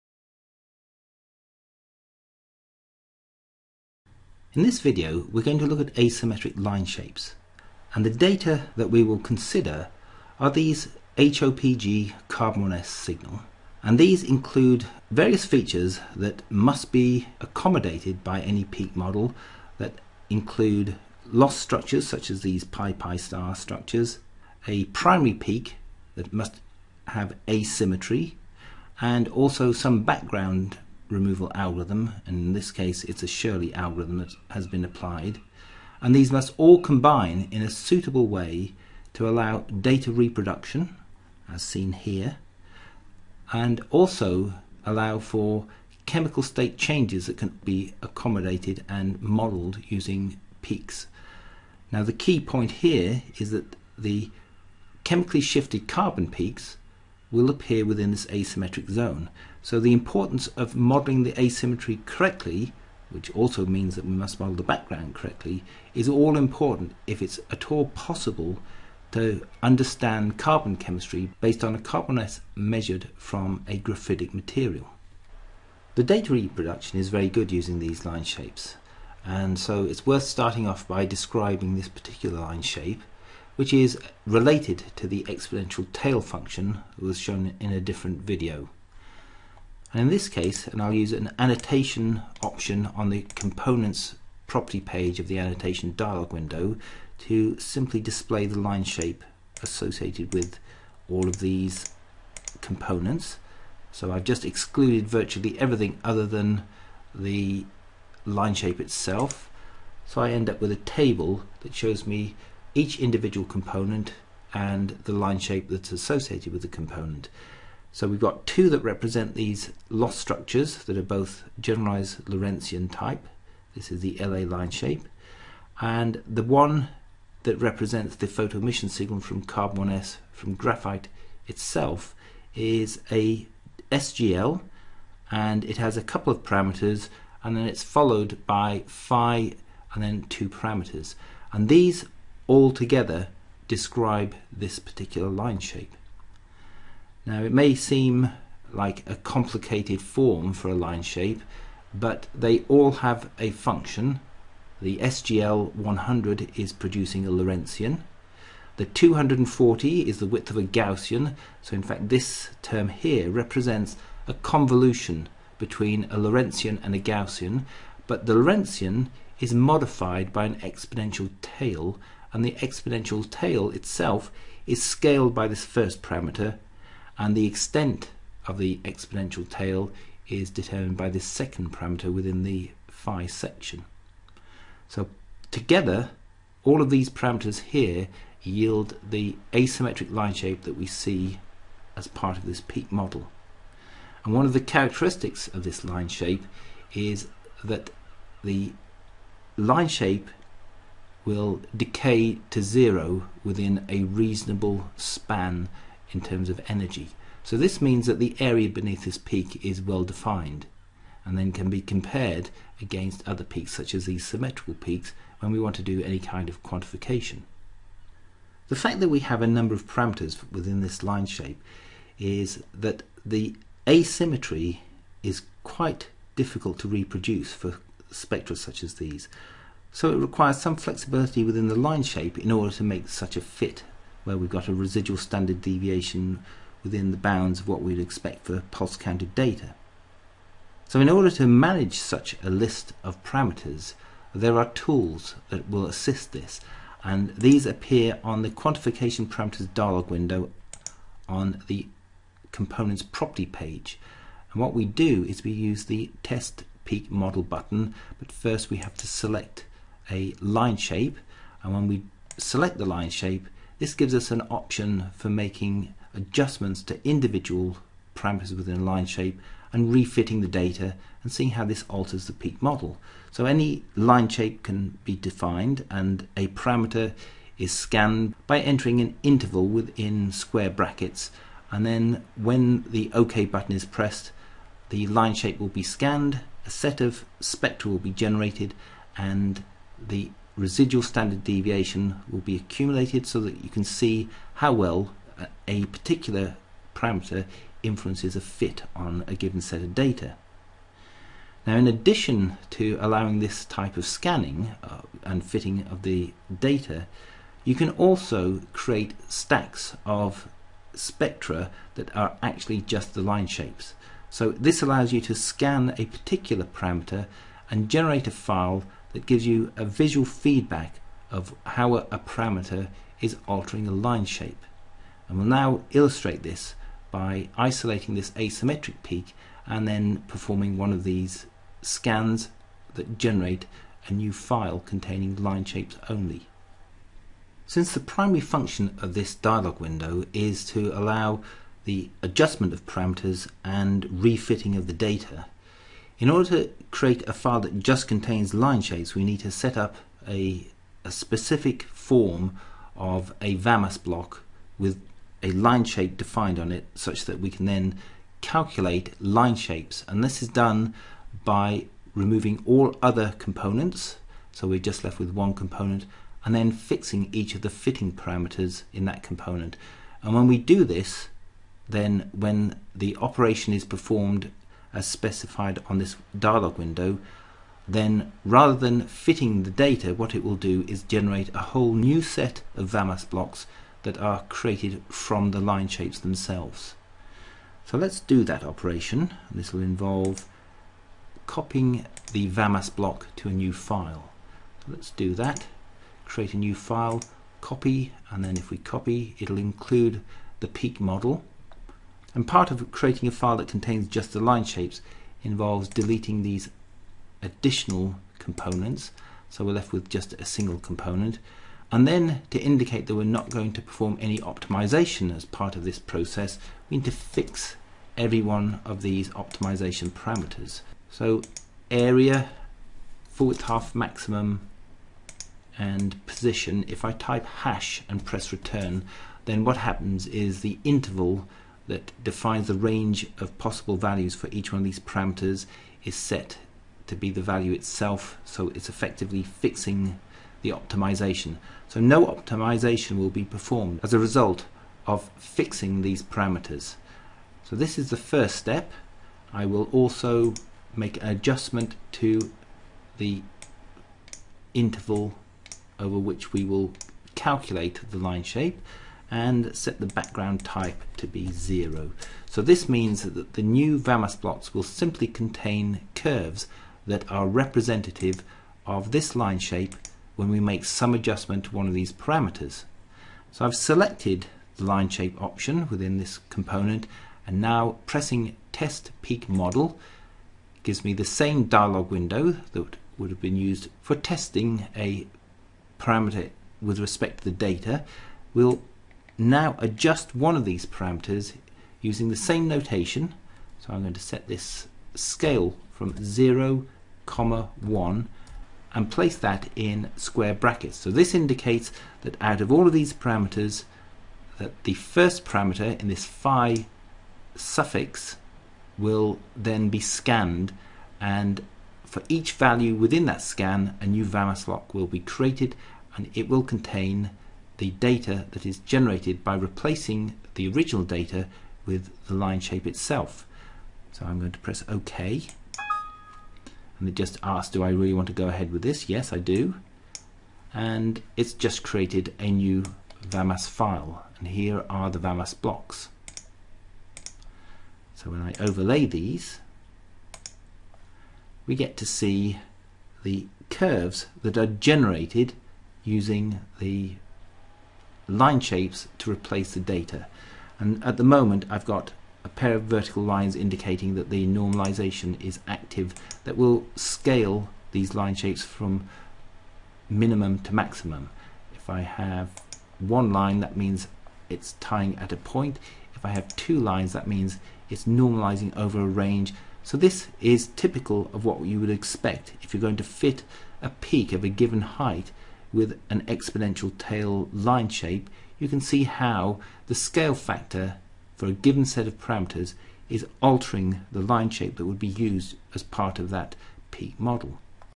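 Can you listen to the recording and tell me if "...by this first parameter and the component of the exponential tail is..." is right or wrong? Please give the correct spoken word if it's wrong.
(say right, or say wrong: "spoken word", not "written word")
wrong: "extent", not "component".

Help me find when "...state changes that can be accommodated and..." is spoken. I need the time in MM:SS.
00:46.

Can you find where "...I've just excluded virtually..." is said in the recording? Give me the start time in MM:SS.
01:44.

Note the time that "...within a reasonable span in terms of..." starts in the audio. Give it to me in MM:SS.
03:23.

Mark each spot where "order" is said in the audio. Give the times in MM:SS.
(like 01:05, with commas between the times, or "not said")
03:52, 04:01, 05:46.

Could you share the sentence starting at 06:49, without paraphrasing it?
So we're left with just a single component.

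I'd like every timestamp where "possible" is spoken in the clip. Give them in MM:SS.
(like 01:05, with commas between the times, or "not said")
01:07, 07:13.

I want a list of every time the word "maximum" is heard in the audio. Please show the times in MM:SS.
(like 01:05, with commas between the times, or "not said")
07:03, 09:20.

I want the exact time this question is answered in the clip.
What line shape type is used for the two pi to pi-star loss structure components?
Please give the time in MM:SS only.
02:04.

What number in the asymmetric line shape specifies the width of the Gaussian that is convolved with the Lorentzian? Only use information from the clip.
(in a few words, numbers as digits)
240.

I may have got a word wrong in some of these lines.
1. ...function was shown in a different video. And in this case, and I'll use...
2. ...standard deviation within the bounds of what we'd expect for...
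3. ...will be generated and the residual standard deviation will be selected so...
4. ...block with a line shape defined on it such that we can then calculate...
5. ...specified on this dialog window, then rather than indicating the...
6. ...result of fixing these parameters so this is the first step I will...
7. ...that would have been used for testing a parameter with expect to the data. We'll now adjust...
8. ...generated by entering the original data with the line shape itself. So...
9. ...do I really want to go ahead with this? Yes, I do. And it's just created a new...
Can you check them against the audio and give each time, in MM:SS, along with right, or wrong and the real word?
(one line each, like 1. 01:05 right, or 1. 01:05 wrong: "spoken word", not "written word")
1. 01:26 right
2. 03:55 right
3. 04:47 wrong: "accumulated", not "selected"
4. 05:54 right
5. 06:15 wrong: "fitting", not "indicating"
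6. 07:24 right
7. 08:02 wrong: "respect", not "expect"
8. 08:38 wrong: "replacing", not "entering"
9. 08:47 right.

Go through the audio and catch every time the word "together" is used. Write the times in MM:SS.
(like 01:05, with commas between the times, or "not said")
02:22, 03:05.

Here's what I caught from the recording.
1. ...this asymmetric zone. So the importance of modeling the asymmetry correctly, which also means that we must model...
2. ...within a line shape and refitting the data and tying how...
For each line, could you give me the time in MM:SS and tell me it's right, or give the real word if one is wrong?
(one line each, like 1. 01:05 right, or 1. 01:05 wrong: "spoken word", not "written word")
1. 00:58 right
2. 04:28 wrong: "seeing", not "tying".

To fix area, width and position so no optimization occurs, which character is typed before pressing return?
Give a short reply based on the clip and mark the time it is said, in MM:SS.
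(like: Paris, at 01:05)
hash, at 07:07.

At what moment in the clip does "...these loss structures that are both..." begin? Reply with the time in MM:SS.
01:59.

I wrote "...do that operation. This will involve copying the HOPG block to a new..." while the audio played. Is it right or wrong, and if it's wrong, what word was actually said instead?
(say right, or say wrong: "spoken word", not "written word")
wrong: "VAMAS", not "HOPG".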